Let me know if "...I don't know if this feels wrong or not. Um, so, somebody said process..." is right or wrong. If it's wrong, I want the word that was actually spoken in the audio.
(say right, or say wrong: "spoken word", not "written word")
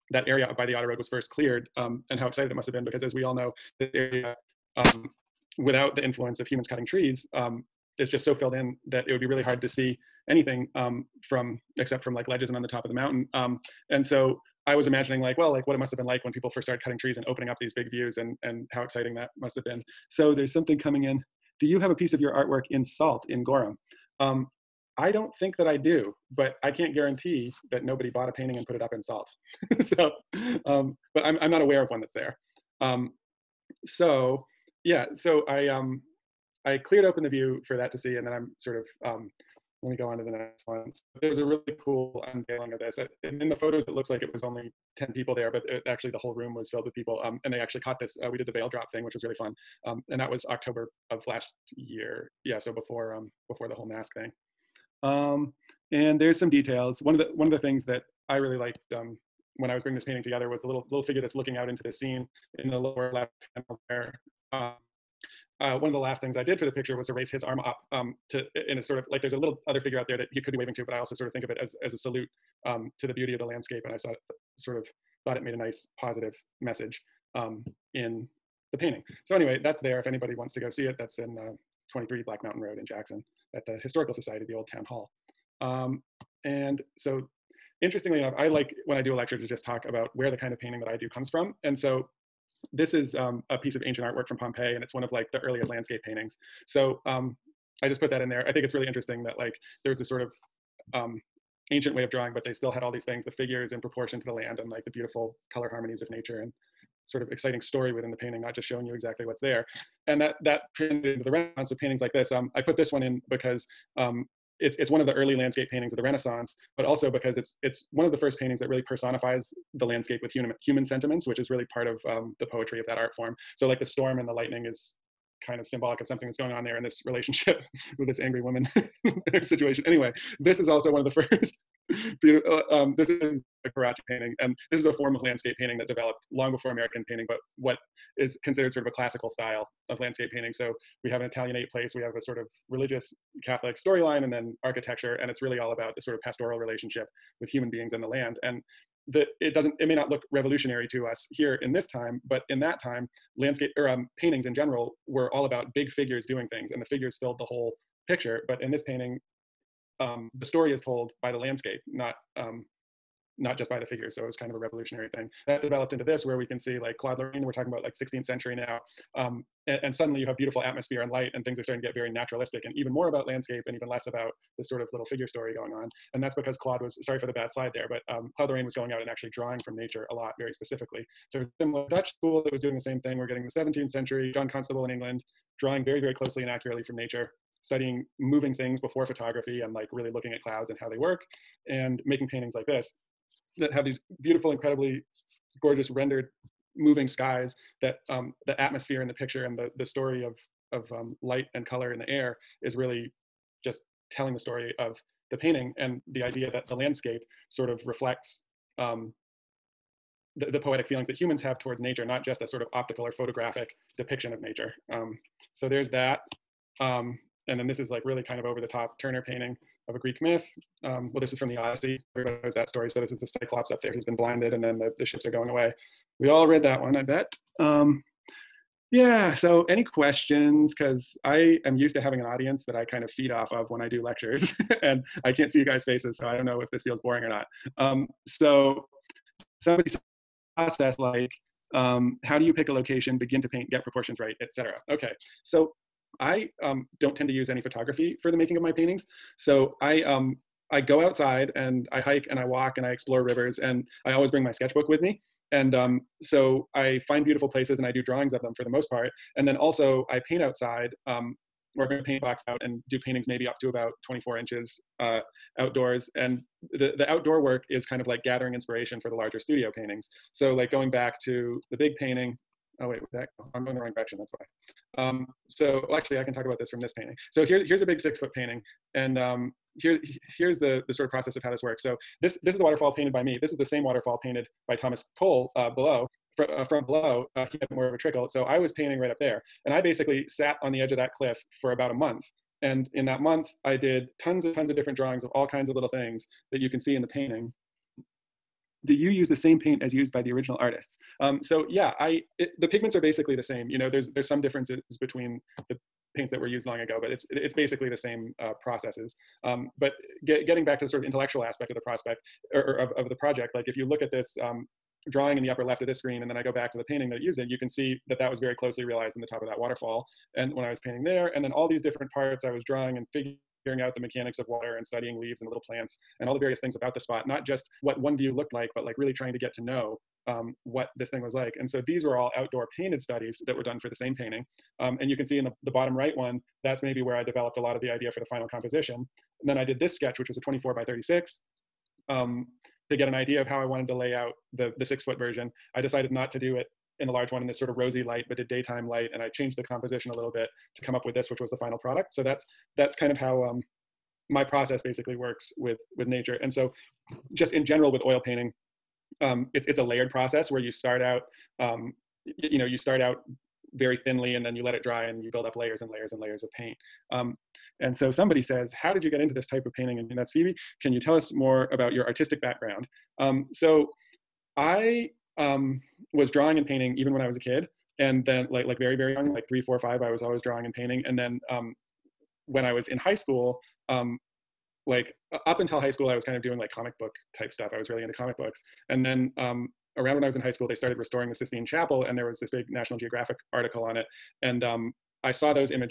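wrong: "boring", not "wrong".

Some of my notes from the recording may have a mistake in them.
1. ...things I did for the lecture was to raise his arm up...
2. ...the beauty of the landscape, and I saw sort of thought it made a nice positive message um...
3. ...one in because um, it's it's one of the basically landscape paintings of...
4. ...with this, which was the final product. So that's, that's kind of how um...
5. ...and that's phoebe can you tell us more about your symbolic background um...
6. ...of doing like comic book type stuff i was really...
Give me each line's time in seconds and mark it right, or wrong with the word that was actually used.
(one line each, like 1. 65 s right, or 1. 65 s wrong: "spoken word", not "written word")
1. 66 s wrong: "picture", not "lecture"
2. 73 s right
3. 112 s wrong: "early", not "basically"
4. 351 s right
5. 370 s wrong: "artistic", not "symbolic"
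6. 386 s right.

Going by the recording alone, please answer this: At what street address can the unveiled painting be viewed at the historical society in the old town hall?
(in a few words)
23 Black Mountain Road.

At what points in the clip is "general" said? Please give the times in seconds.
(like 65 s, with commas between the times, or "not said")
154 s, 357 s.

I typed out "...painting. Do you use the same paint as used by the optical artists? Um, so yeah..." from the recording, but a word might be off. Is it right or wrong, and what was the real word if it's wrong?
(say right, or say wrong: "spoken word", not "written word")
wrong: "original", not "optical".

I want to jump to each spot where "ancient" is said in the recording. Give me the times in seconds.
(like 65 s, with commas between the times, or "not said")
93 s, 101 s.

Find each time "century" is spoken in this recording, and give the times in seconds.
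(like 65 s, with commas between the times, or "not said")
168 s, 183 s.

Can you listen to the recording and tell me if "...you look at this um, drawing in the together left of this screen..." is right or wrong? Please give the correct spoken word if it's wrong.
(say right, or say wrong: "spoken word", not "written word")
wrong: "upper", not "together".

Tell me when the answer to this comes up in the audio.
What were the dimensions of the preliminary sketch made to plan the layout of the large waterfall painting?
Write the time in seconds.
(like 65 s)
340 s.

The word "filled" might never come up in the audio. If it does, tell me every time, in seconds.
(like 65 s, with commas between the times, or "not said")
8 s, 46 s, 157 s.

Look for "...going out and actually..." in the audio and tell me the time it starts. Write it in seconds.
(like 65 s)
178 s.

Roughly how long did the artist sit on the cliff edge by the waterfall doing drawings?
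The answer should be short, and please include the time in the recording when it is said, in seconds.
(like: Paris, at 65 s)
About a month, at 291 s.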